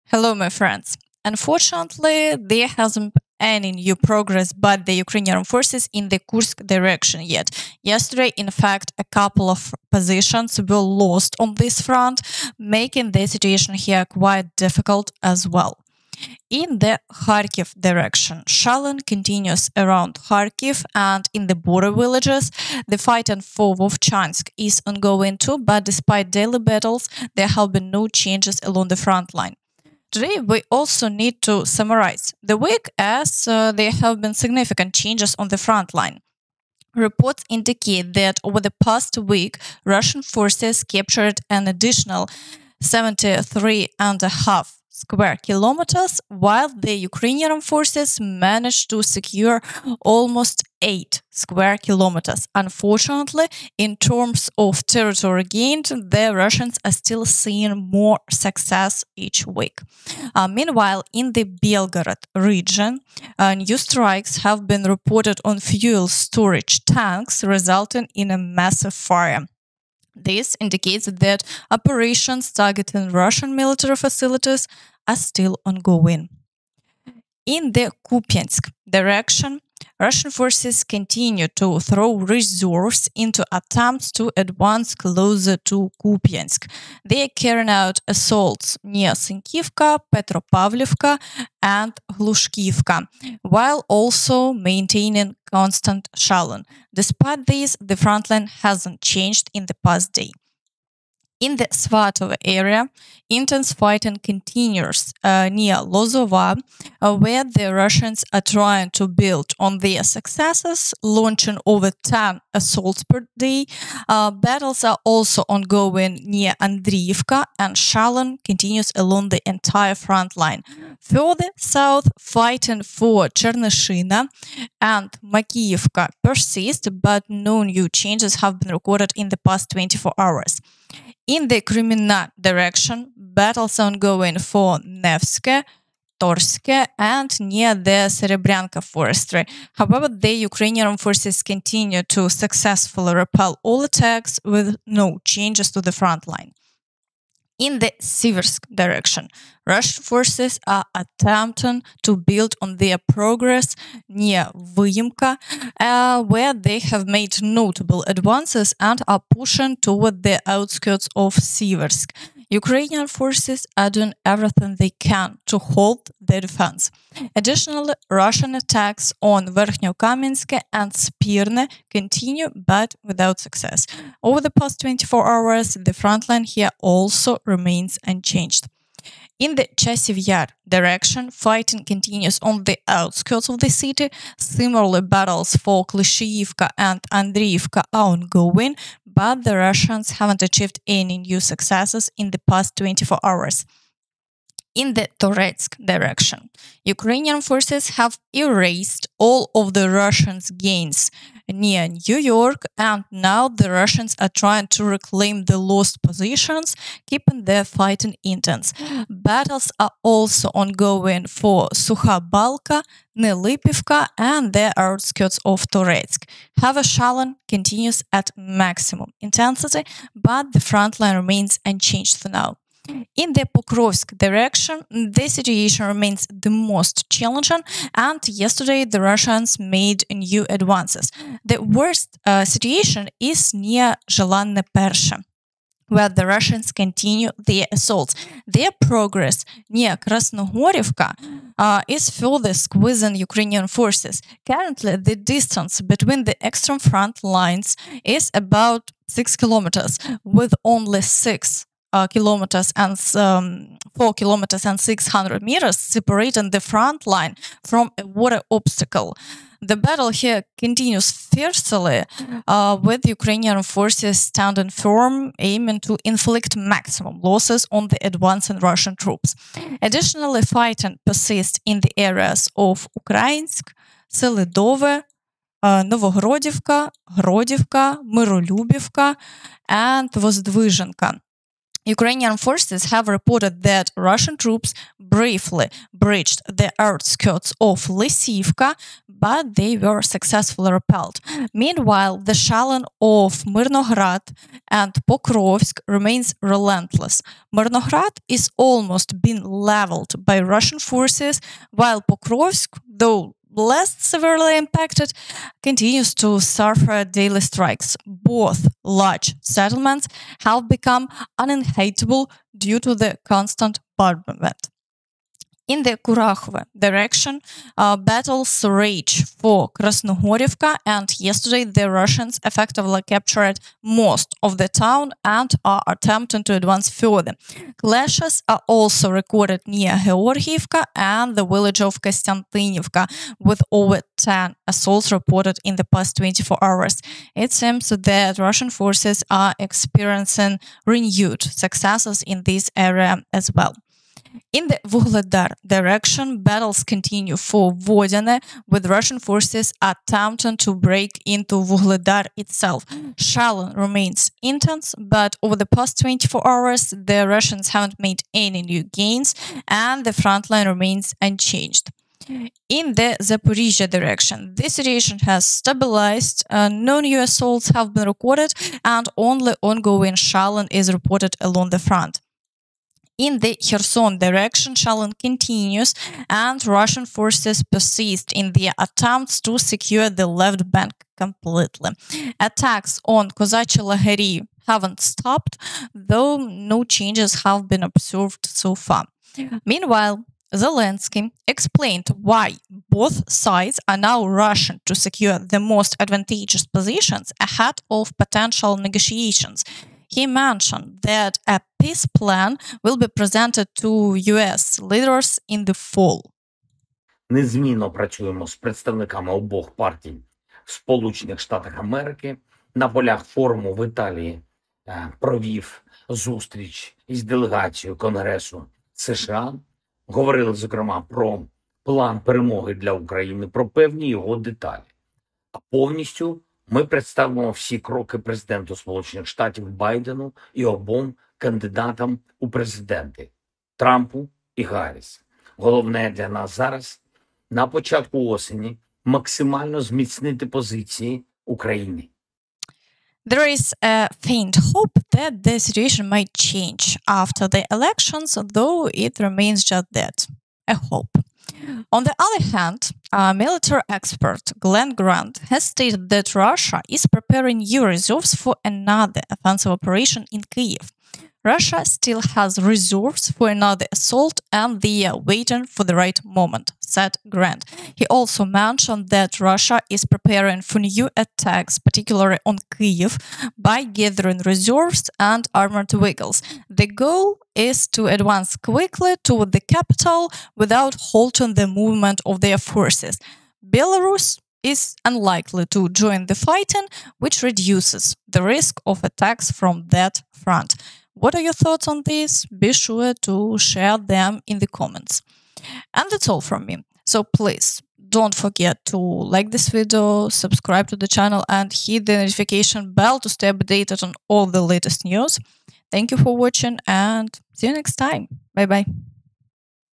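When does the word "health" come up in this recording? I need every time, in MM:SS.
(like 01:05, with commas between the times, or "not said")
not said.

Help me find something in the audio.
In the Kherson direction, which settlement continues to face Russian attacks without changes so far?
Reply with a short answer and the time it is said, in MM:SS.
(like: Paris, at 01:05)
Kozachi Laheri, at 06:23.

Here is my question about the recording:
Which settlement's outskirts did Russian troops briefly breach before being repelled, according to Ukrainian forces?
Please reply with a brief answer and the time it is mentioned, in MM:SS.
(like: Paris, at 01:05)
Lysivka, at 04:47.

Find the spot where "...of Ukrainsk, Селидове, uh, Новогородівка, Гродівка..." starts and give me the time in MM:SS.
04:32.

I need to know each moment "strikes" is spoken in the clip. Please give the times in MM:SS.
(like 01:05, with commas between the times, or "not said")
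01:03, 05:07.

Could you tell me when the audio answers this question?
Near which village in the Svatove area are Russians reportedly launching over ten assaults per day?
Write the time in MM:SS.
01:45.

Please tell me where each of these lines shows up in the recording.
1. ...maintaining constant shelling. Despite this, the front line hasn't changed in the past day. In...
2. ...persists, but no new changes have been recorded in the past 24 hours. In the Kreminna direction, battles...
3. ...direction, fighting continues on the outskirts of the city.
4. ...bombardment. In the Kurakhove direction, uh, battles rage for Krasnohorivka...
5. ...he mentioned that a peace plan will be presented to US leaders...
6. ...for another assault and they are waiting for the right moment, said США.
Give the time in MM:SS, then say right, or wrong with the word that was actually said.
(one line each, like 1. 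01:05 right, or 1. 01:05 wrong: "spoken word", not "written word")
1. 01:34 right
2. 02:06 right
3. 03:00 right
4. 05:13 right
5. 06:40 right
6. 07:43 wrong: "Grant", not "США".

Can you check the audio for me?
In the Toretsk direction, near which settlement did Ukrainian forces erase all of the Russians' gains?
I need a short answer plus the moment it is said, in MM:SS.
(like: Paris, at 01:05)
New York, at 03:22.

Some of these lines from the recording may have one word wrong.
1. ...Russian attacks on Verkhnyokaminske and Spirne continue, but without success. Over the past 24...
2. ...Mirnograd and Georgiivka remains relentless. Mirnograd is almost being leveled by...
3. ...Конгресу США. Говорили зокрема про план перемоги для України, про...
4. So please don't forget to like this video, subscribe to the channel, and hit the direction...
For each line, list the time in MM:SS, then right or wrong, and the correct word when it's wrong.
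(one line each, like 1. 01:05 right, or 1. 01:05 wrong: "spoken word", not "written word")
1. 02:48 right
2. 04:53 wrong: "Pokrovsk", not "Georgiivka"
3. 06:57 right
4. 08:17 wrong: "notification", not "direction".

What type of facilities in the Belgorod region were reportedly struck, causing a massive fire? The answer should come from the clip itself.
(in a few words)
Fuel storage tanks.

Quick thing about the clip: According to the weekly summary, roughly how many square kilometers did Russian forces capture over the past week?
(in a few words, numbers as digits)
73.5.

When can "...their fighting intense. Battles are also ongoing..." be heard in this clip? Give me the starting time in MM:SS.
03:27.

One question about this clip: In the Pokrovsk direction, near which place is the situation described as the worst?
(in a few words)
Zhelanne Persha.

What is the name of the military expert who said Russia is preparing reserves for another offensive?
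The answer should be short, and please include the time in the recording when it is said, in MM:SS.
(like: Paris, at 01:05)
Glen Grant, at 07:34.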